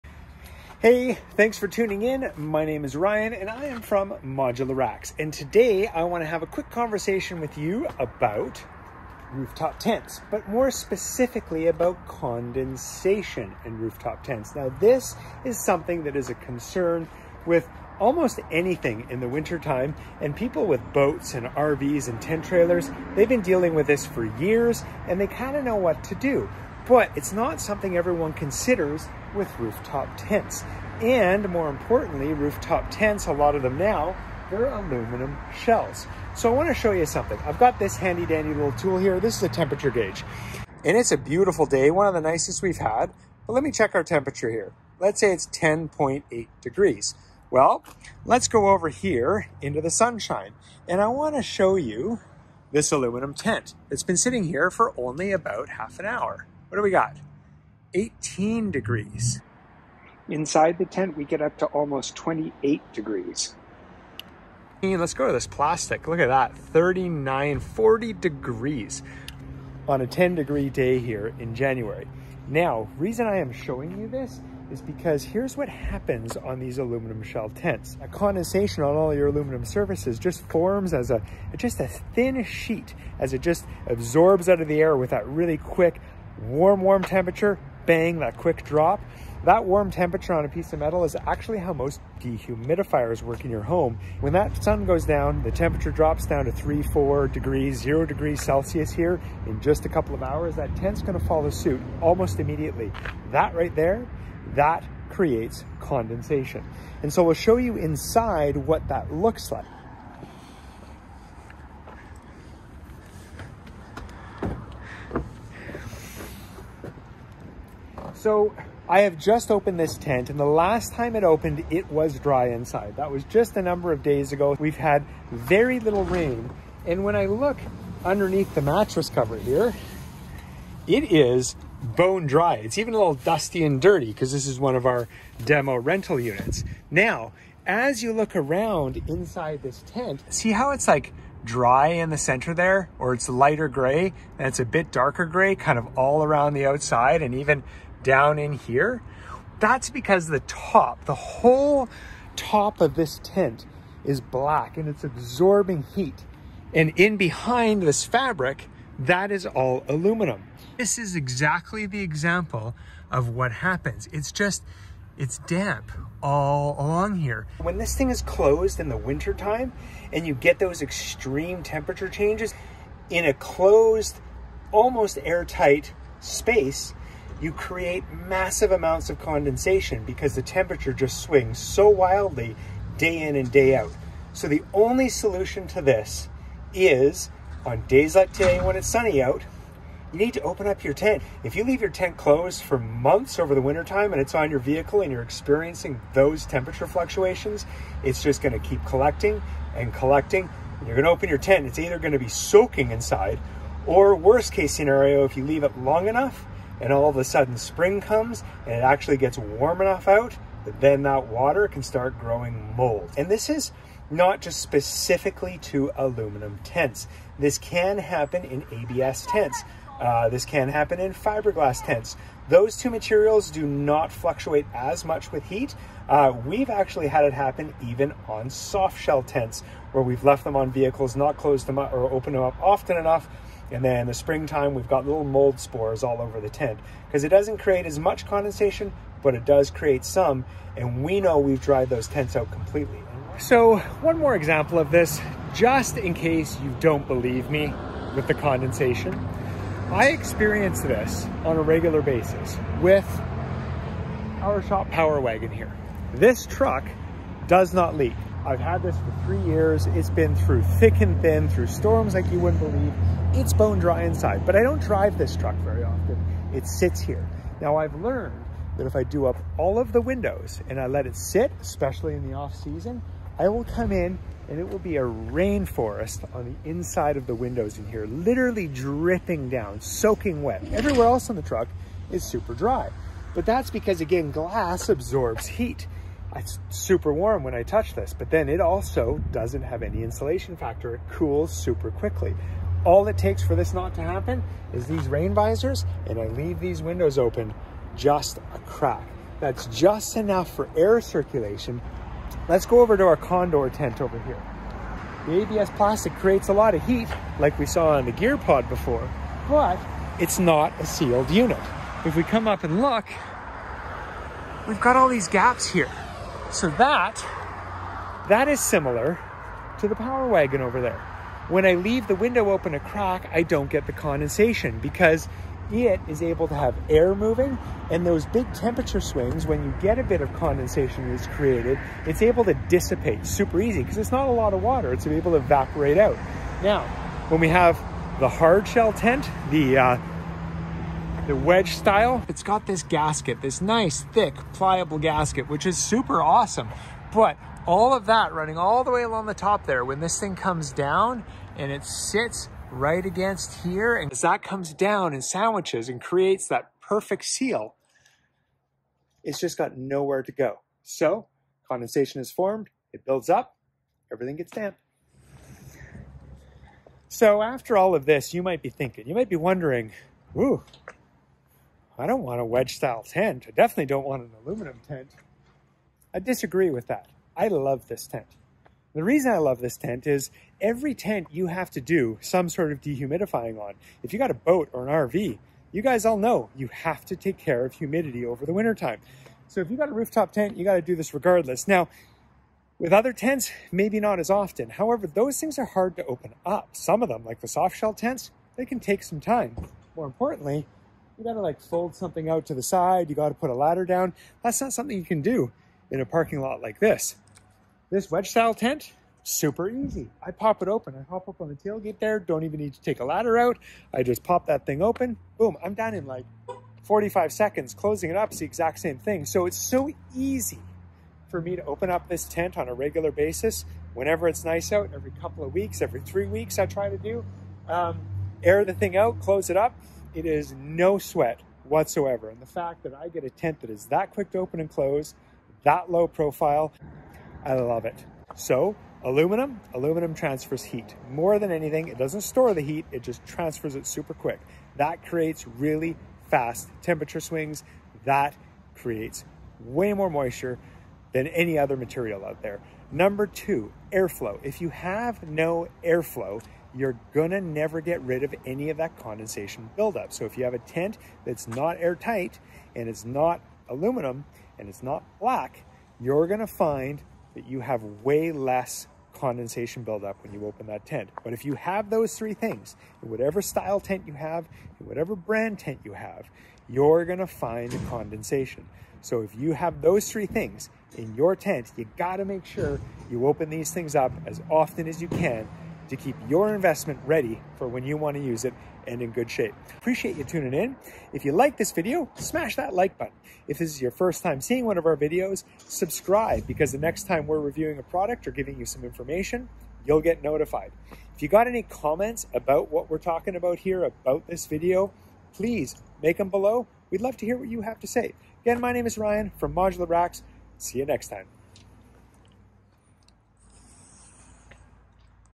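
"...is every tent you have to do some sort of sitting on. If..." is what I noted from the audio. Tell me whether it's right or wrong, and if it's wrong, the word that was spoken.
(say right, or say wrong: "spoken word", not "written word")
wrong: "dehumidifying", not "sitting".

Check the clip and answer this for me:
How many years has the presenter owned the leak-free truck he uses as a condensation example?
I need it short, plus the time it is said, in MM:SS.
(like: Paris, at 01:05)
3, at 04:19.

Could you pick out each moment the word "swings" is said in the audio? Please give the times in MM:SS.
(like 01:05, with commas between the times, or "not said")
03:01, 05:28, 07:27.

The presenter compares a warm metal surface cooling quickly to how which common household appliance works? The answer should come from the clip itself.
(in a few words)
dehumidifiers.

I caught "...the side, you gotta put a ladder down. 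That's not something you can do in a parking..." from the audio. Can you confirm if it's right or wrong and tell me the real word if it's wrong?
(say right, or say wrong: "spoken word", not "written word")
right.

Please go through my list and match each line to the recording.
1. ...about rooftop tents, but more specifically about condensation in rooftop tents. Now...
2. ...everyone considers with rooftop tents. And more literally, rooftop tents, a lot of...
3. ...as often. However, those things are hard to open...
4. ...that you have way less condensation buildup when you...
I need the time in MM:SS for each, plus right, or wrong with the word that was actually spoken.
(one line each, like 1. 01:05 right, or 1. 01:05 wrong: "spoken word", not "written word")
1. 00:07 right
2. 00:27 wrong: "importantly", not "literally"
3. 06:34 right
4. 07:47 right.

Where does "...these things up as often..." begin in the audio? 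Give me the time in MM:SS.
08:03.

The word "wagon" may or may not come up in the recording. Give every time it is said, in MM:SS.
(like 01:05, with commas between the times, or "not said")
04:15, 05:20.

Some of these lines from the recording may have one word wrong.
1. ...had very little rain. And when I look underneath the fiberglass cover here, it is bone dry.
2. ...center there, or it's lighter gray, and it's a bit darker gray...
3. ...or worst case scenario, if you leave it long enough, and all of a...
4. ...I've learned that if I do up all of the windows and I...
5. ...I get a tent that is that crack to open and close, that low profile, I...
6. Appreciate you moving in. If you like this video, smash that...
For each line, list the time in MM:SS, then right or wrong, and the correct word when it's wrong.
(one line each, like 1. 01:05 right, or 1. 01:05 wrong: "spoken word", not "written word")
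1. 02:04 wrong: "mattress", not "fiberglass"
2. 02:22 right
3. 03:23 right
4. 04:27 right
5. 07:12 wrong: "quick", not "crack"
6. 08:09 wrong: "tuning", not "moving".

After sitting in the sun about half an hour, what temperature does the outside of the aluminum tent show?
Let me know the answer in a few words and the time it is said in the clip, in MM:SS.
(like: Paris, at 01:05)
18 degrees, at 00:57.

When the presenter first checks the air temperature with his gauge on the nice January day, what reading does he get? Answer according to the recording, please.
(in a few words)
10.8 degrees.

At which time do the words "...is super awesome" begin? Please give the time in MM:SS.
05:45.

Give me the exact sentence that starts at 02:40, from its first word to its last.
This is exactly the example of what happens.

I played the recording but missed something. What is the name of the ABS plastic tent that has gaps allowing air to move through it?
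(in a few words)
Condor.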